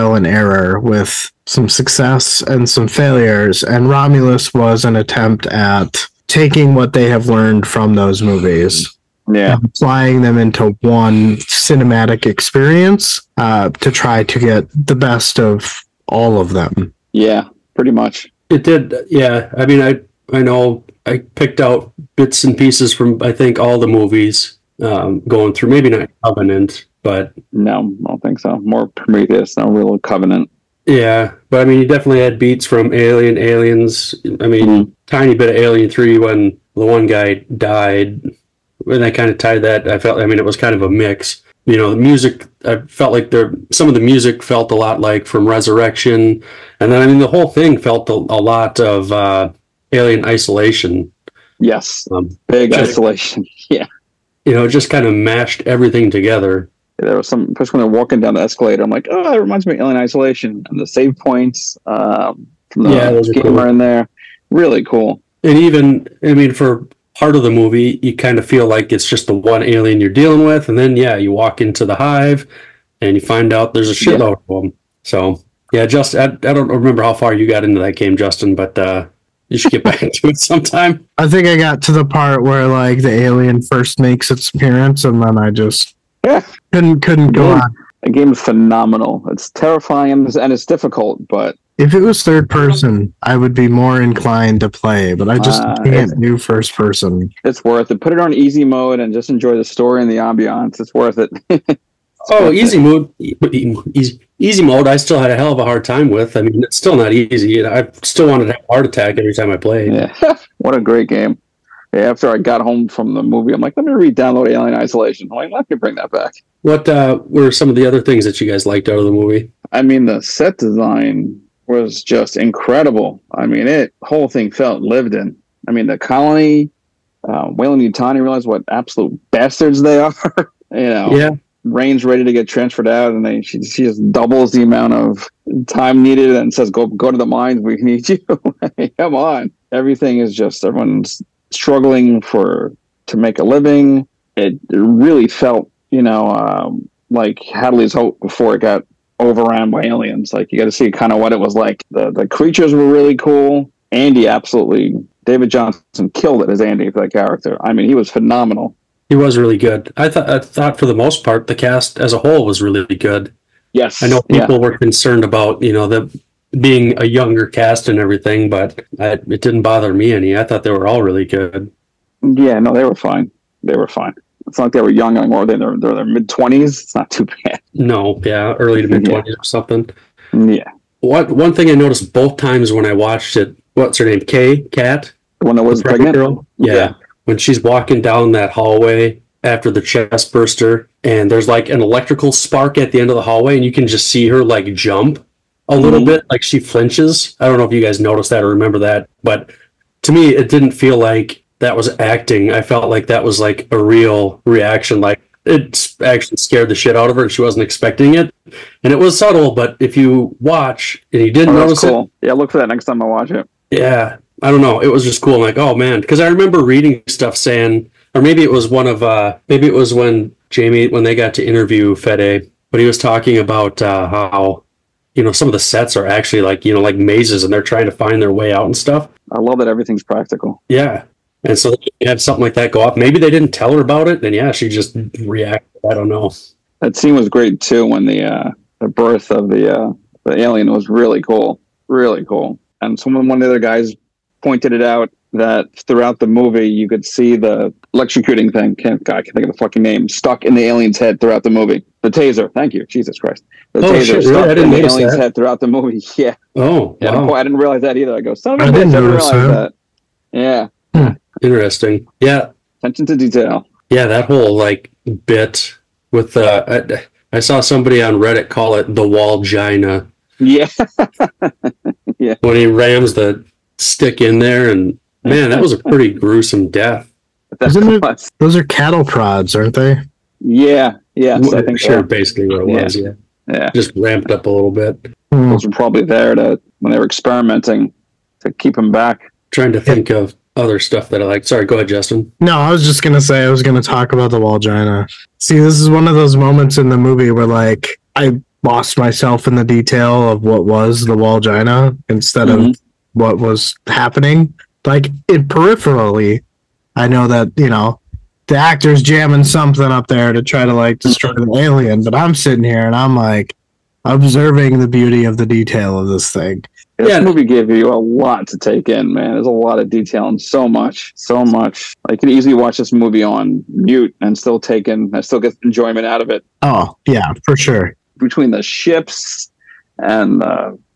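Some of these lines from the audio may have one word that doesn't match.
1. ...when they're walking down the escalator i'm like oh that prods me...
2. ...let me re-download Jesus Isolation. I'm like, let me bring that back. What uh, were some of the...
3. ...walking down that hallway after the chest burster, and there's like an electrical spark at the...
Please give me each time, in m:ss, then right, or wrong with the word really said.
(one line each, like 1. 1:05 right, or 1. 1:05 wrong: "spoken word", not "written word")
1. 0:57 wrong: "reminds", not "prods"
2. 1:53 wrong: "Alien", not "Jesus"
3. 3:07 right.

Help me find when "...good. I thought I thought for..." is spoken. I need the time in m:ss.
2:39.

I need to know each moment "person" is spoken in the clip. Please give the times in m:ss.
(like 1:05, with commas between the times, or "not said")
1:32, 1:36.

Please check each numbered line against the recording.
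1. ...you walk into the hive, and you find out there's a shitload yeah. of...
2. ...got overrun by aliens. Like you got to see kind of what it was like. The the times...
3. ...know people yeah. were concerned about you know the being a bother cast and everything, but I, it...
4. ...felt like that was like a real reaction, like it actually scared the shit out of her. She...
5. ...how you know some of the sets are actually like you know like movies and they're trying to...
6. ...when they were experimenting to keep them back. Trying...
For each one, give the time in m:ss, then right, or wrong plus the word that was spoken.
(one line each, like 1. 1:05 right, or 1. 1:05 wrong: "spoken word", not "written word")
1. 1:11 right
2. 2:28 wrong: "creatures", not "times"
3. 2:44 wrong: "younger", not "bother"
4. 3:22 right
5. 3:44 wrong: "mazes", not "movies"
6. 4:46 right.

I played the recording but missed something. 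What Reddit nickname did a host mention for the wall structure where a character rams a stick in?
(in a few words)
Wall gina.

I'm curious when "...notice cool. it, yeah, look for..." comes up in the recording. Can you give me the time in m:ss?
3:31.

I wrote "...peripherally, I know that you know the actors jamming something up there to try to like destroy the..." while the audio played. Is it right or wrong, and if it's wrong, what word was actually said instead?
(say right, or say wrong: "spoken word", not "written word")
right.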